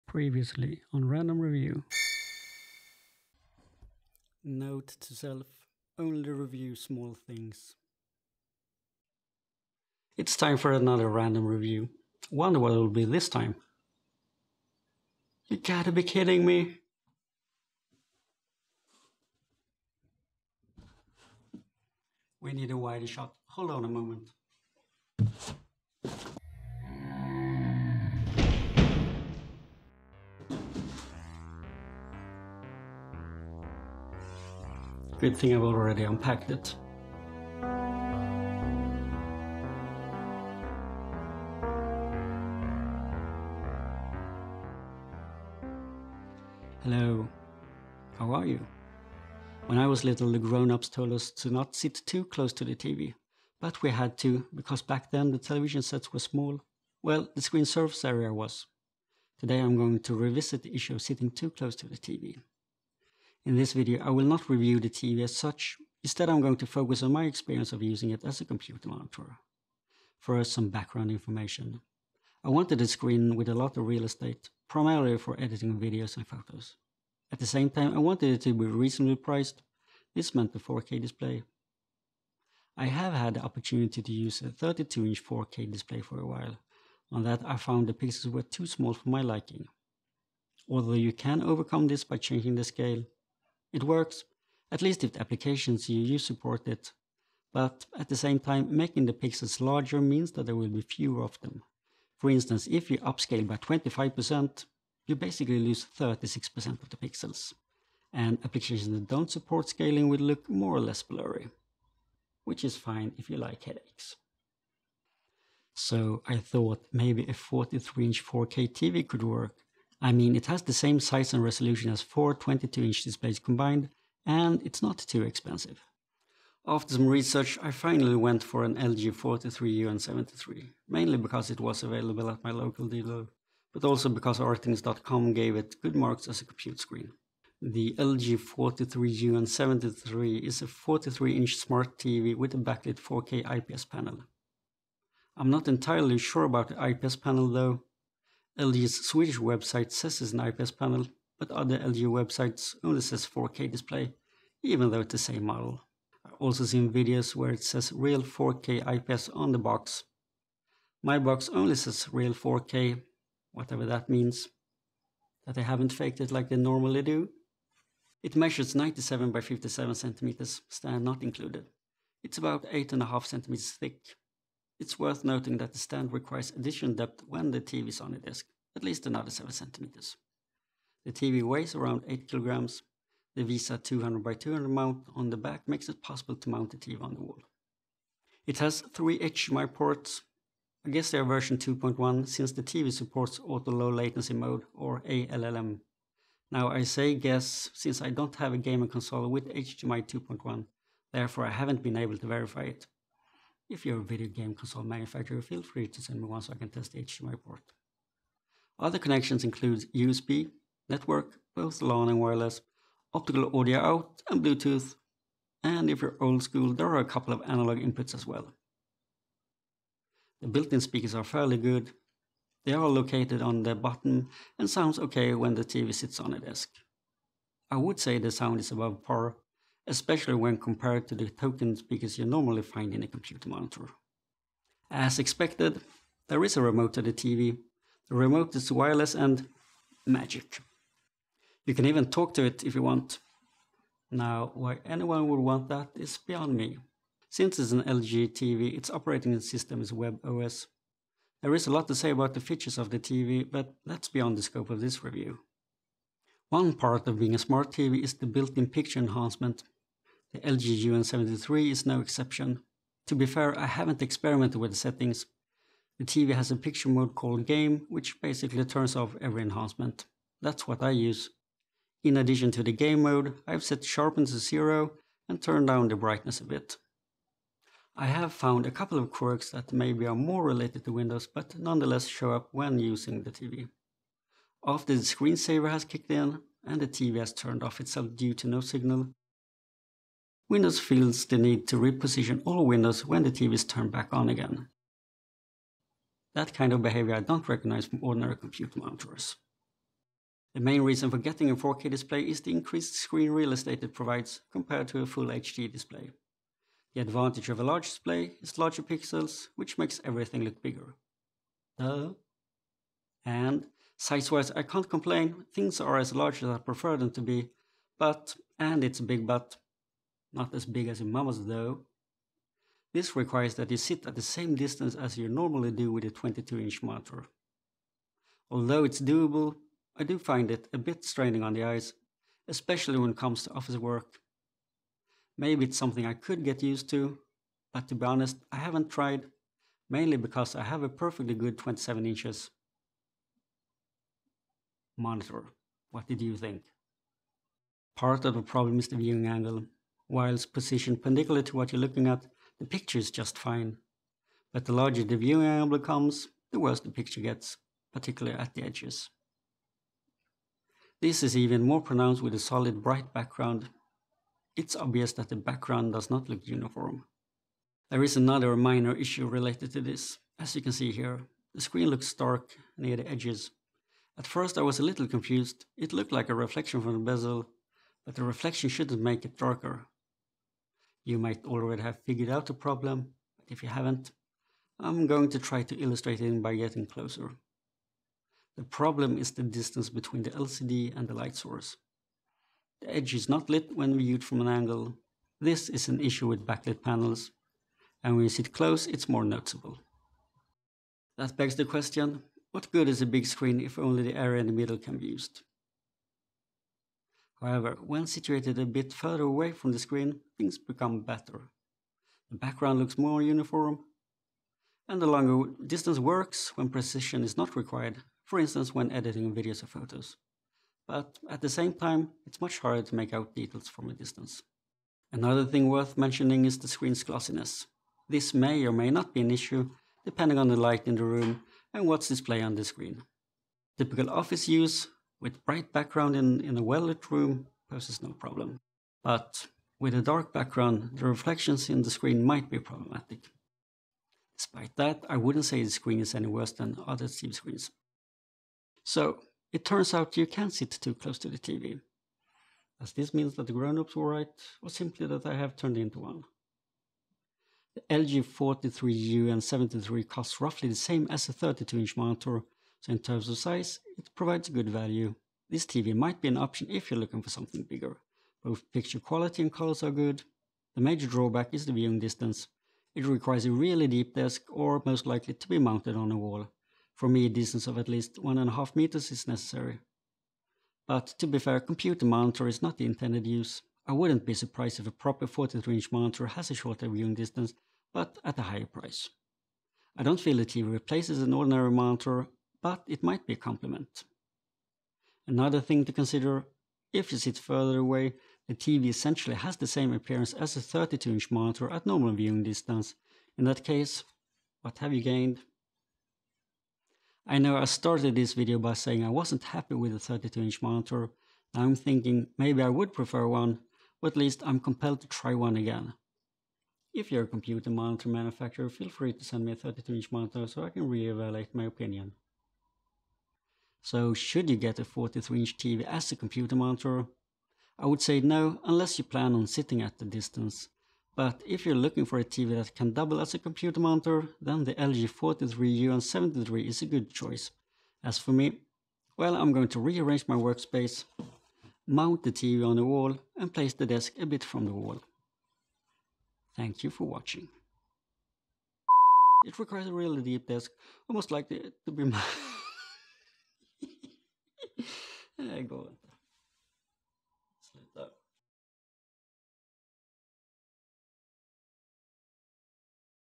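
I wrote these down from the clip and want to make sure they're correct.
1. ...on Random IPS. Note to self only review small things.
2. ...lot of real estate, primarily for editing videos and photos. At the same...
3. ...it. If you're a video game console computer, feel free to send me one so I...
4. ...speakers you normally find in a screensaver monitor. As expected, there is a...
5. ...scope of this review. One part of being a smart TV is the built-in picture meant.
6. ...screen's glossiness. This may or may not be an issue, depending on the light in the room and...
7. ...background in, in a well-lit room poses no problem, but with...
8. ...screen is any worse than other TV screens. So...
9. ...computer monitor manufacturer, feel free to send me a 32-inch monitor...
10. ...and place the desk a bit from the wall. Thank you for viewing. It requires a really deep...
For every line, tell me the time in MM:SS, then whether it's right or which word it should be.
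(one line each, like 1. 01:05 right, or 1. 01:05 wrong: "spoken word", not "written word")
1. 00:00 wrong: "Review", not "IPS"
2. 01:13 right
3. 03:22 wrong: "manufacturer", not "computer"
4. 03:51 wrong: "computer", not "screensaver"
5. 04:14 wrong: "enhancement", not "meant"
6. 07:06 right
7. 07:15 right
8. 07:25 right
9. 08:37 right
10. 09:03 wrong: "watching", not "viewing".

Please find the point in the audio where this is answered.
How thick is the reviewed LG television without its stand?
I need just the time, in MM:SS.
02:52.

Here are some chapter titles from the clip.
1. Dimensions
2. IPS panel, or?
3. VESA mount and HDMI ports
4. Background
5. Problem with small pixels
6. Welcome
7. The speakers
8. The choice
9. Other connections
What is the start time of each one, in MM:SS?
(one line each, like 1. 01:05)
1. 02:48
2. 02:20
3. 03:01
4. 01:02
5. 01:26
6. 00:45
7. 03:39
8. 02:02
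9. 03:29.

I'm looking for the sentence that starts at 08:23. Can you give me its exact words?
In that case, what have you gained?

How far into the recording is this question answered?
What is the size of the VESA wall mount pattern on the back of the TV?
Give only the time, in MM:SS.
03:03.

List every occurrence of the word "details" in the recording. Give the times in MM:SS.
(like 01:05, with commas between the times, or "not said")
07:03.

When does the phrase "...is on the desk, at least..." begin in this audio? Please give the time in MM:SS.
02:57.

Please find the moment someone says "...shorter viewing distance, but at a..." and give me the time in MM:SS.
08:06.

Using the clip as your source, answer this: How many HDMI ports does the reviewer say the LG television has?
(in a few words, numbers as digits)
3.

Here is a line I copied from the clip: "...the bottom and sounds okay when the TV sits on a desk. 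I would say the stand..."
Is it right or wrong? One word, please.
wrong.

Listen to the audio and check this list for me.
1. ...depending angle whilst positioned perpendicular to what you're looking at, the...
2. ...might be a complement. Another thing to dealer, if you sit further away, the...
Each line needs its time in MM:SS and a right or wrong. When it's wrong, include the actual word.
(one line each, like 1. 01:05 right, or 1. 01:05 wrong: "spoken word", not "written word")
1. 05:48 wrong: "viewing", not "depending"
2. 08:13 wrong: "consider", not "dealer".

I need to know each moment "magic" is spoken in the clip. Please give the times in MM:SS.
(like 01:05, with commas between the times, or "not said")
04:00.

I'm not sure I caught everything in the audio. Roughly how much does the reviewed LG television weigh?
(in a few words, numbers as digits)
8 kilograms.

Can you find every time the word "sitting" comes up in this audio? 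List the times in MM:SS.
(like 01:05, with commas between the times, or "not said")
01:01, 08:49.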